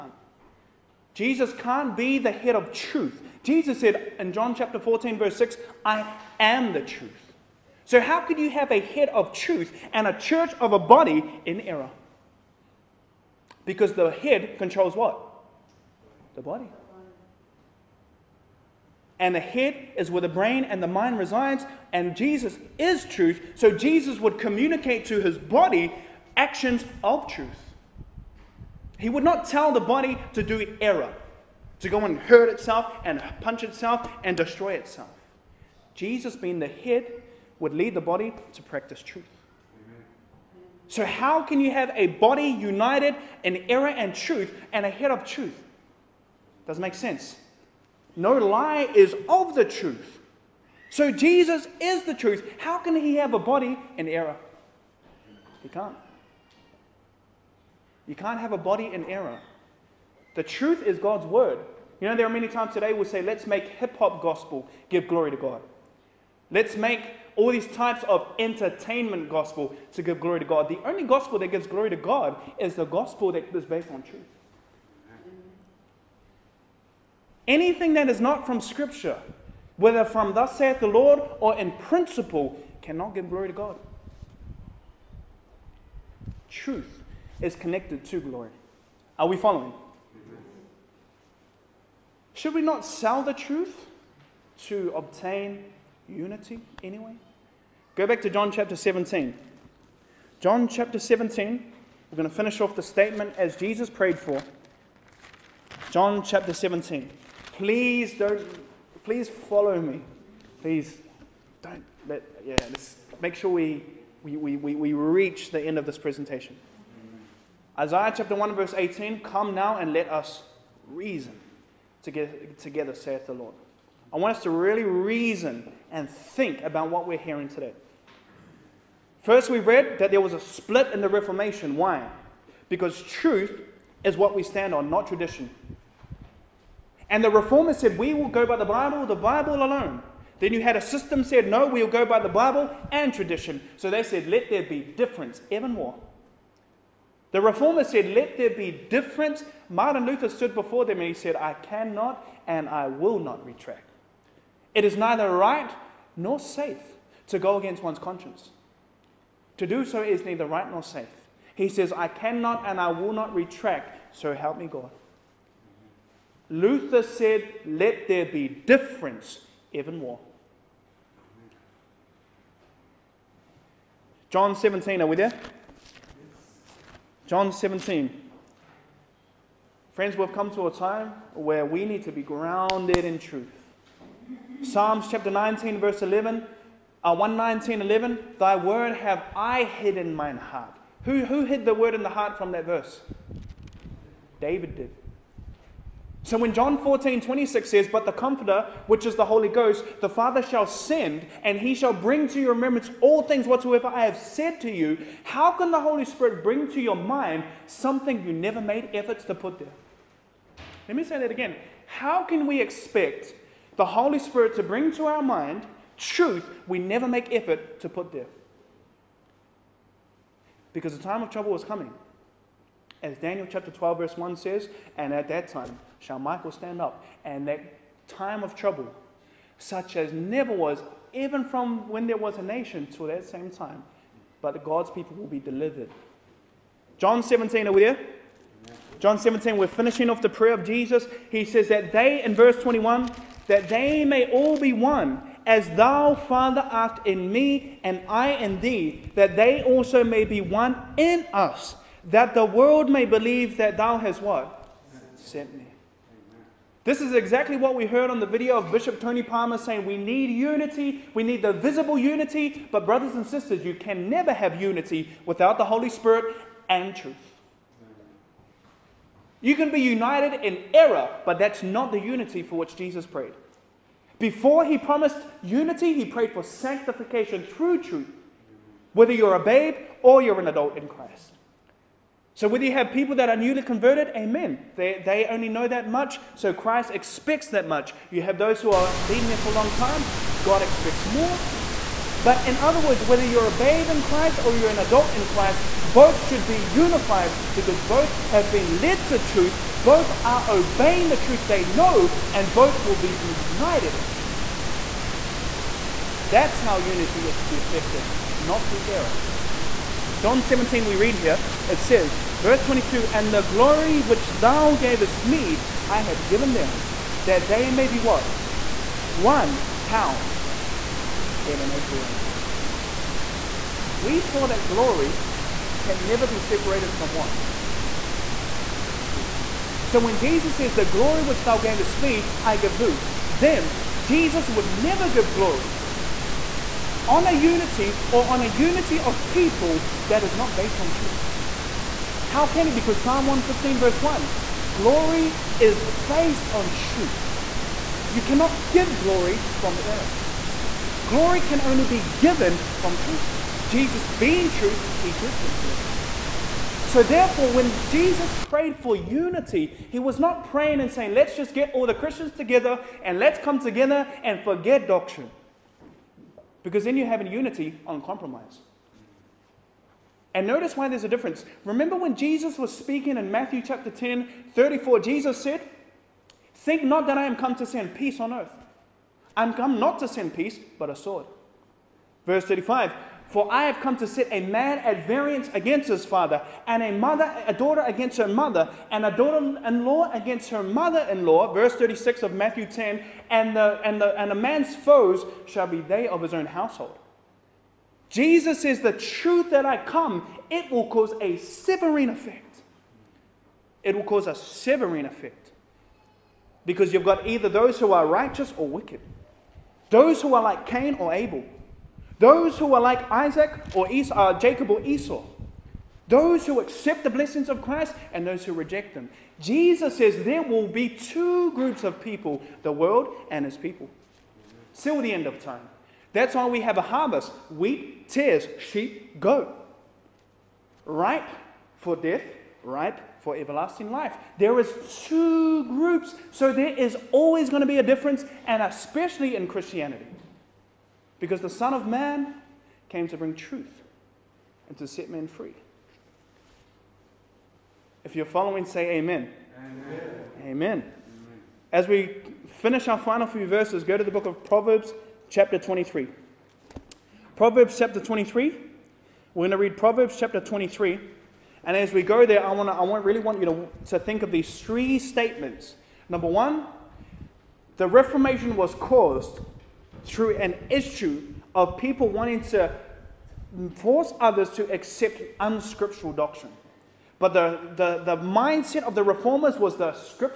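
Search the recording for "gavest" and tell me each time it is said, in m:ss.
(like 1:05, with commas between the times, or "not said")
5:14, 5:31.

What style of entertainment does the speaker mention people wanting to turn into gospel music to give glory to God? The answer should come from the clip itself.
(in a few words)
Hip hop.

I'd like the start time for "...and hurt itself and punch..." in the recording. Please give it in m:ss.
0:32.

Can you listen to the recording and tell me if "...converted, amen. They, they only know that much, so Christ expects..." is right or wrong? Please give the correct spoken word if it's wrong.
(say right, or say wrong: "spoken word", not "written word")
right.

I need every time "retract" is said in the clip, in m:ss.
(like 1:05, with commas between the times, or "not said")
2:33, 2:43.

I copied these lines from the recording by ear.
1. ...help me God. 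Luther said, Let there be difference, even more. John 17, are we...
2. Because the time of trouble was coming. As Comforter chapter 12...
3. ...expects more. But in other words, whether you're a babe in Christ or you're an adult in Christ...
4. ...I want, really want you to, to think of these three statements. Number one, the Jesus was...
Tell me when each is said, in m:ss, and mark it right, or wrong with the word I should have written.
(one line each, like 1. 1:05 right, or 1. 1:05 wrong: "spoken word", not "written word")
1. 2:44 right
2. 3:40 wrong: "Daniel", not "Comforter"
3. 4:50 right
4. 7:42 wrong: "Reformation", not "Jesus".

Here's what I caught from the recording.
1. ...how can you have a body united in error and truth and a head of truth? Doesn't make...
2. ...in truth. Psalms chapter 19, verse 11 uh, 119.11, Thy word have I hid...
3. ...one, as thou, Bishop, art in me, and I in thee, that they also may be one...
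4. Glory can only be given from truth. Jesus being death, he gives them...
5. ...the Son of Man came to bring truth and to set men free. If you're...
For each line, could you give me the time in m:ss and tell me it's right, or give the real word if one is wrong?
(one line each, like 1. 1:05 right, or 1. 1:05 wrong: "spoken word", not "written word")
1. 0:41 right
2. 3:03 right
3. 4:04 wrong: "Father", not "Bishop"
4. 5:51 wrong: "truth", not "death"
5. 7:21 right.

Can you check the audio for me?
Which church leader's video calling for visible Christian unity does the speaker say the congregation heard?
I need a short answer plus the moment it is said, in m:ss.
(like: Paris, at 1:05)
Bishop Tony Palmer, at 4:18.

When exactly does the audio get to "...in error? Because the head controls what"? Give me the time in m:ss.
0:11.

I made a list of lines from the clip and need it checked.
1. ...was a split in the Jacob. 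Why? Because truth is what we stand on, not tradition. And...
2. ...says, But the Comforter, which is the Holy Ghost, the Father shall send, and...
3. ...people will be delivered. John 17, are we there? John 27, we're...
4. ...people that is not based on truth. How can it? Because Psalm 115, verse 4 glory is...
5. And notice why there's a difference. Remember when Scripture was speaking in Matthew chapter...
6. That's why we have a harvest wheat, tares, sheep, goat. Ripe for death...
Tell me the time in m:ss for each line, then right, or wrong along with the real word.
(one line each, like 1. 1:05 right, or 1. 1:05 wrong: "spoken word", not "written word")
1. 2:10 wrong: "Reformation", not "Jacob"
2. 3:17 right
3. 3:54 wrong: "17", not "27"
4. 5:39 wrong: "1", not "4"
5. 6:10 wrong: "Jesus", not "Scripture"
6. 7:06 right.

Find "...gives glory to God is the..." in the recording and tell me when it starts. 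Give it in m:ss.
1:11.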